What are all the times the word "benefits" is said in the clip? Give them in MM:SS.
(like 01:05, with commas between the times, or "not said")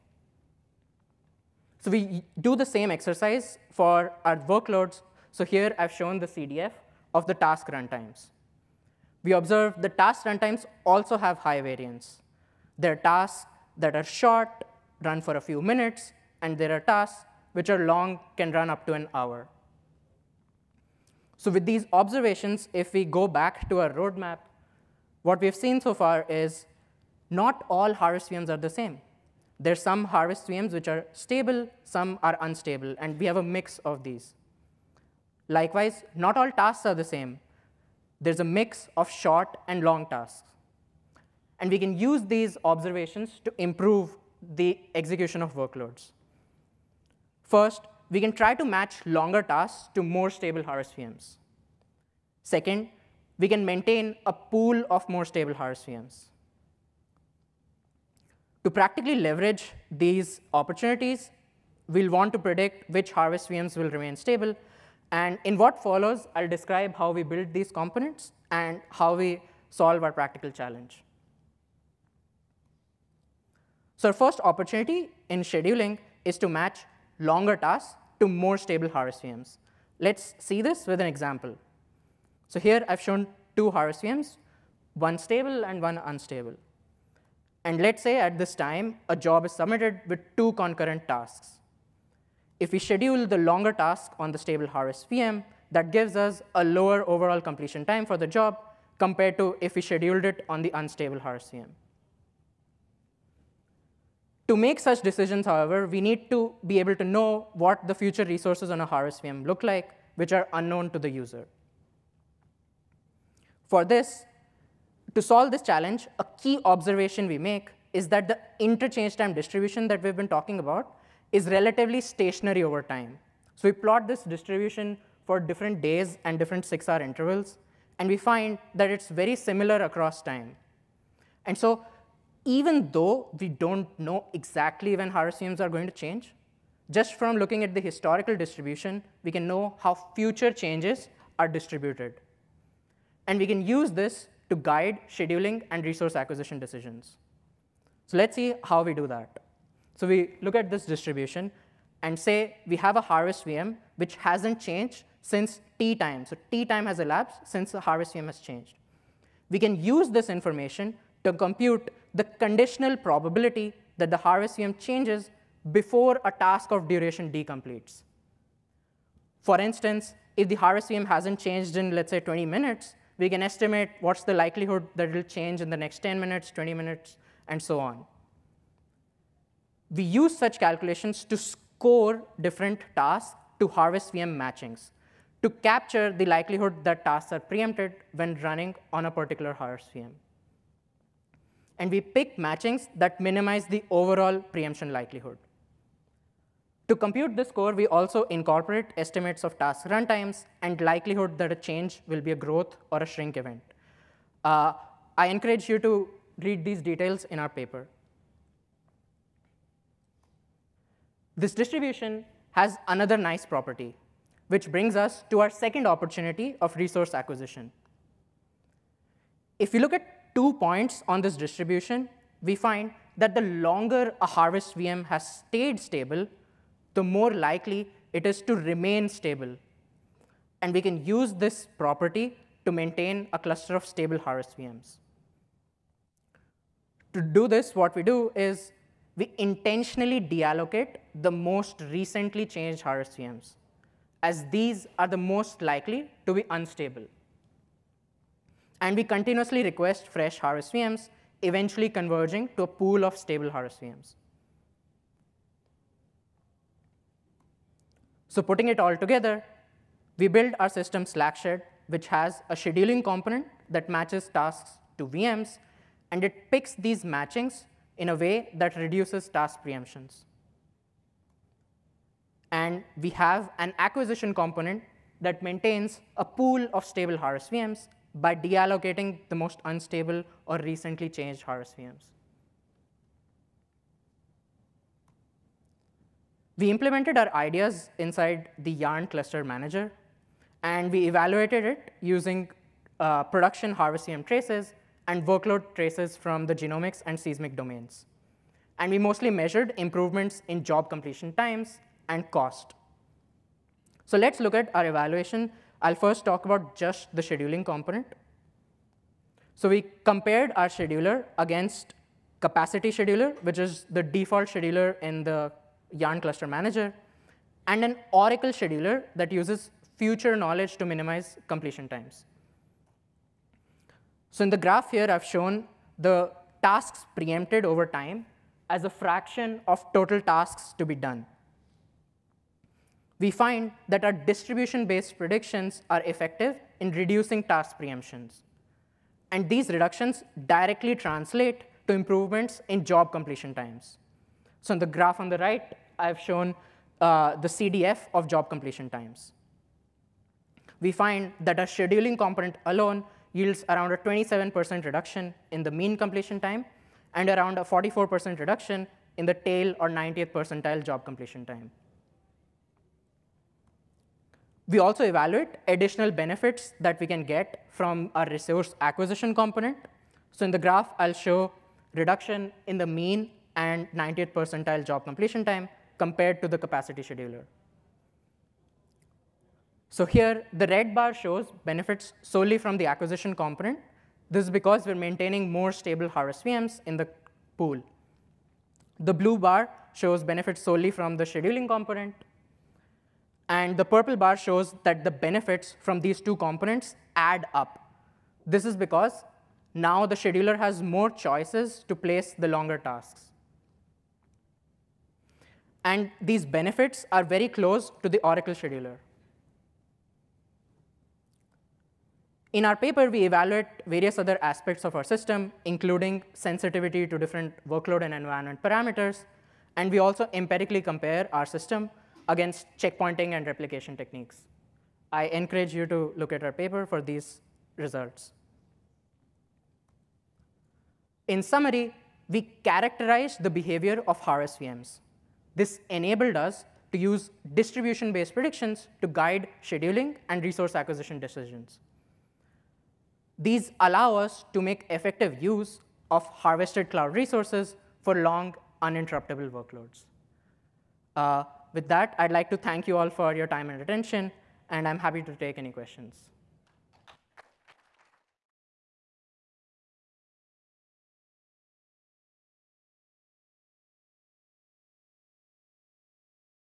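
06:06, 06:21, 06:30, 06:35, 06:46.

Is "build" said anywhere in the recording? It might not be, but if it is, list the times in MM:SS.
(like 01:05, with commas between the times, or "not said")
01:07, 04:20.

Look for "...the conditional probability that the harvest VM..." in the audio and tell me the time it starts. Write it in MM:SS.
02:42.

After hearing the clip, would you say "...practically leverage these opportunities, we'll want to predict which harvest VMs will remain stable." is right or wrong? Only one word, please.
right.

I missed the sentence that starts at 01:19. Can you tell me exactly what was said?
Let's see this with an example.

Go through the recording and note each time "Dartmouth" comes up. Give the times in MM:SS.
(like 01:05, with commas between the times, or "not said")
not said.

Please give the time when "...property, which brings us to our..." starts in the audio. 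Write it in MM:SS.
03:33.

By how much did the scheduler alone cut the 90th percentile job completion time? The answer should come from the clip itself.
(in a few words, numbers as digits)
44%.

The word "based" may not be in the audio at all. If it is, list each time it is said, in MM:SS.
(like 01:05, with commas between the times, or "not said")
05:34, 07:17.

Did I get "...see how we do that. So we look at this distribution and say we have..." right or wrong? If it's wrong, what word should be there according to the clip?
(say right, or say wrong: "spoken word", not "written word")
right.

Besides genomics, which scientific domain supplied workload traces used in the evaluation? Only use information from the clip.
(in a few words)
seismic.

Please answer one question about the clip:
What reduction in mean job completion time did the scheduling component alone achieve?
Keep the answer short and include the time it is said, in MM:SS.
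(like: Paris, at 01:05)
27%, at 05:53.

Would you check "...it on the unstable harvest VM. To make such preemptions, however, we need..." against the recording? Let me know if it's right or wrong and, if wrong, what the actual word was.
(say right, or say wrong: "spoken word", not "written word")
wrong: "decisions", not "preemptions".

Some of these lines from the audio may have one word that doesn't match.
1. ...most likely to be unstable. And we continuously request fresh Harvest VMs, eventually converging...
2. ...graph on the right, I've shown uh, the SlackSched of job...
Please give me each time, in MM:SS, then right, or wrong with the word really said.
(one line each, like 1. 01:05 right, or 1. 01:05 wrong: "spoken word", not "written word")
1. 04:05 right
2. 05:44 wrong: "CDF", not "SlackSched".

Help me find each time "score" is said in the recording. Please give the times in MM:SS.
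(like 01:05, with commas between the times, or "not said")
03:01, 03:17.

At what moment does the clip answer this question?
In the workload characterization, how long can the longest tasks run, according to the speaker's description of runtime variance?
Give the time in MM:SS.
00:18.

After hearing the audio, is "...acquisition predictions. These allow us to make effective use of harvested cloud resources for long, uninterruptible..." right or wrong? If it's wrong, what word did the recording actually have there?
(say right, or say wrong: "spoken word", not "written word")
wrong: "decisions", not "predictions".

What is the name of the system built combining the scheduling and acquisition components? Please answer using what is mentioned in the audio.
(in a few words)
SlackSched.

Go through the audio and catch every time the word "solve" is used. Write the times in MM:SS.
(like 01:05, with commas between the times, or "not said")
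01:09, 01:55.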